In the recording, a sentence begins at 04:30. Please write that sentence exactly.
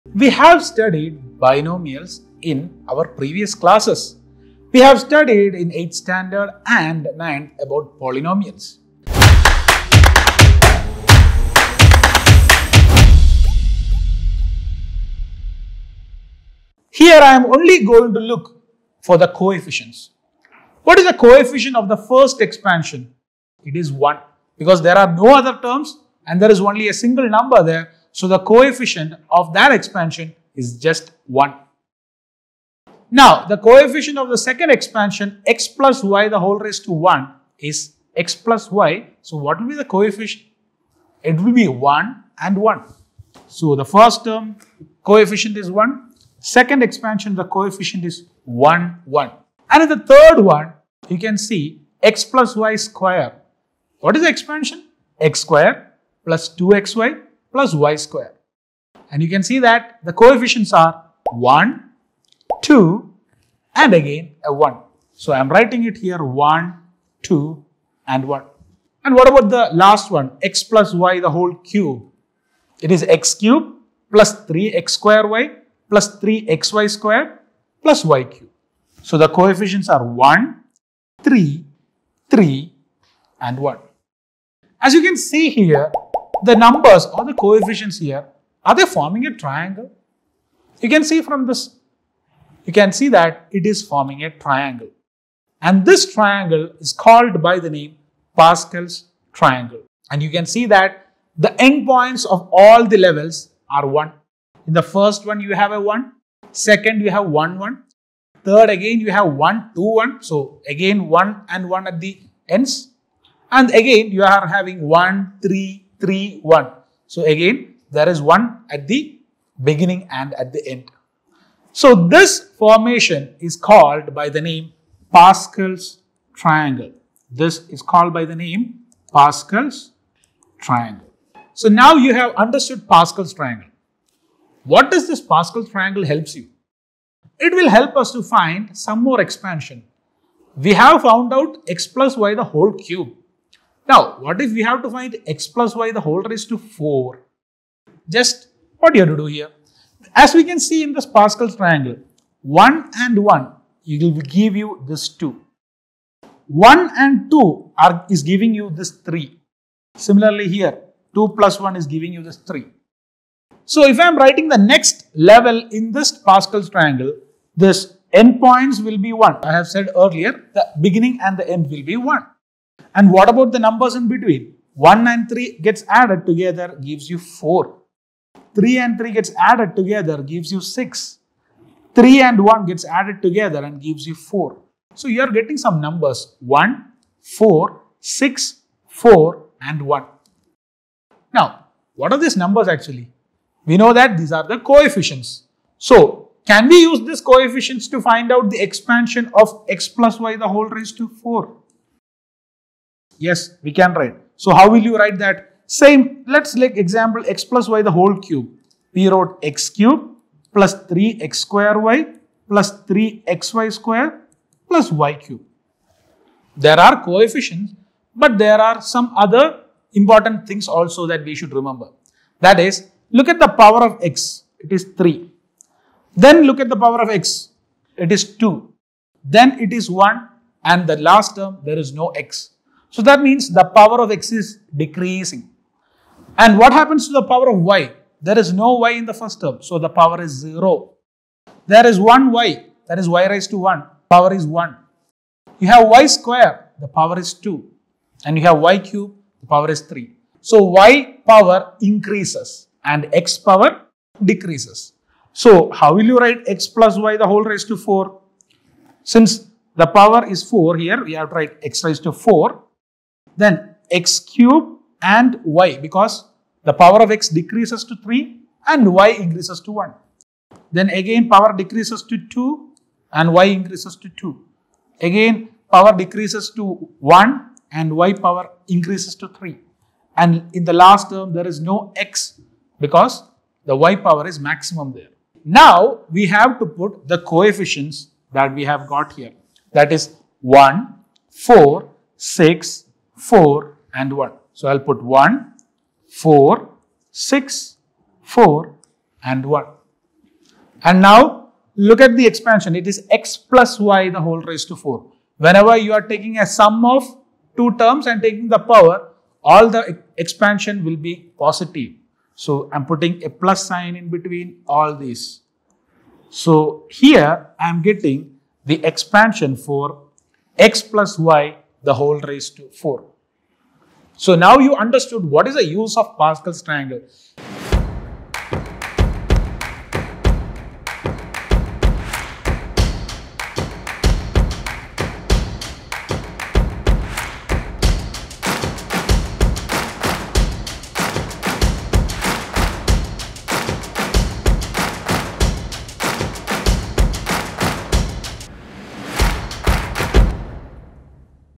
Then again power decreases to 2 and y increases to 2.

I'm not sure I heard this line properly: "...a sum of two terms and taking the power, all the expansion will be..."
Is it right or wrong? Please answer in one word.
right.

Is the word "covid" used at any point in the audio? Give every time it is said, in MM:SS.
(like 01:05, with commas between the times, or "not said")
not said.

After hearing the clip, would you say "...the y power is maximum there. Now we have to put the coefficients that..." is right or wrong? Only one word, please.
right.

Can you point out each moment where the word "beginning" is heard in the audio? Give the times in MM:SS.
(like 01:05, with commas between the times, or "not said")
01:59, 02:50.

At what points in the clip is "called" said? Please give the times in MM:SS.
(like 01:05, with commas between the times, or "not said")
01:36, 02:03, 02:07.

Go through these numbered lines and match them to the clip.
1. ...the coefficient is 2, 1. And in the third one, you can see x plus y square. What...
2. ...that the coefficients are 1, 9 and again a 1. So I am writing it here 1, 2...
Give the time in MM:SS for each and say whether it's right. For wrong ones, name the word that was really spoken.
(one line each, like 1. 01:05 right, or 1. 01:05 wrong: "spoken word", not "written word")
1. 00:47 wrong: "1", not "2"
2. 00:59 wrong: "2", not "9".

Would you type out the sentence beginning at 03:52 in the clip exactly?
So that means the power of x is decreasing.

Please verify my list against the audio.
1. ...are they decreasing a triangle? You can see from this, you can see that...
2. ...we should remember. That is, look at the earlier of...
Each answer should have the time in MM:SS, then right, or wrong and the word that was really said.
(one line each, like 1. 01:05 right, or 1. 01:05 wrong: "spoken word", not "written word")
1. 01:28 wrong: "forming", not "decreasing"
2. 03:41 wrong: "power", not "earlier".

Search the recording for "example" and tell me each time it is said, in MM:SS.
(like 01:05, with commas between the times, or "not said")
03:26.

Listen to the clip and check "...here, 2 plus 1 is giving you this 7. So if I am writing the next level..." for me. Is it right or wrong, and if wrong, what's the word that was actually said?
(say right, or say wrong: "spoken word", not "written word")
wrong: "3", not "7".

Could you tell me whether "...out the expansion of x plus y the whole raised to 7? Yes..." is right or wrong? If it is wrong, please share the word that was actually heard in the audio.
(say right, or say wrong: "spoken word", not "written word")
wrong: "4", not "7".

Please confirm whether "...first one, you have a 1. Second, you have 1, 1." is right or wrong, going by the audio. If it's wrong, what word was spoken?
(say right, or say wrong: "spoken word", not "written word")
right.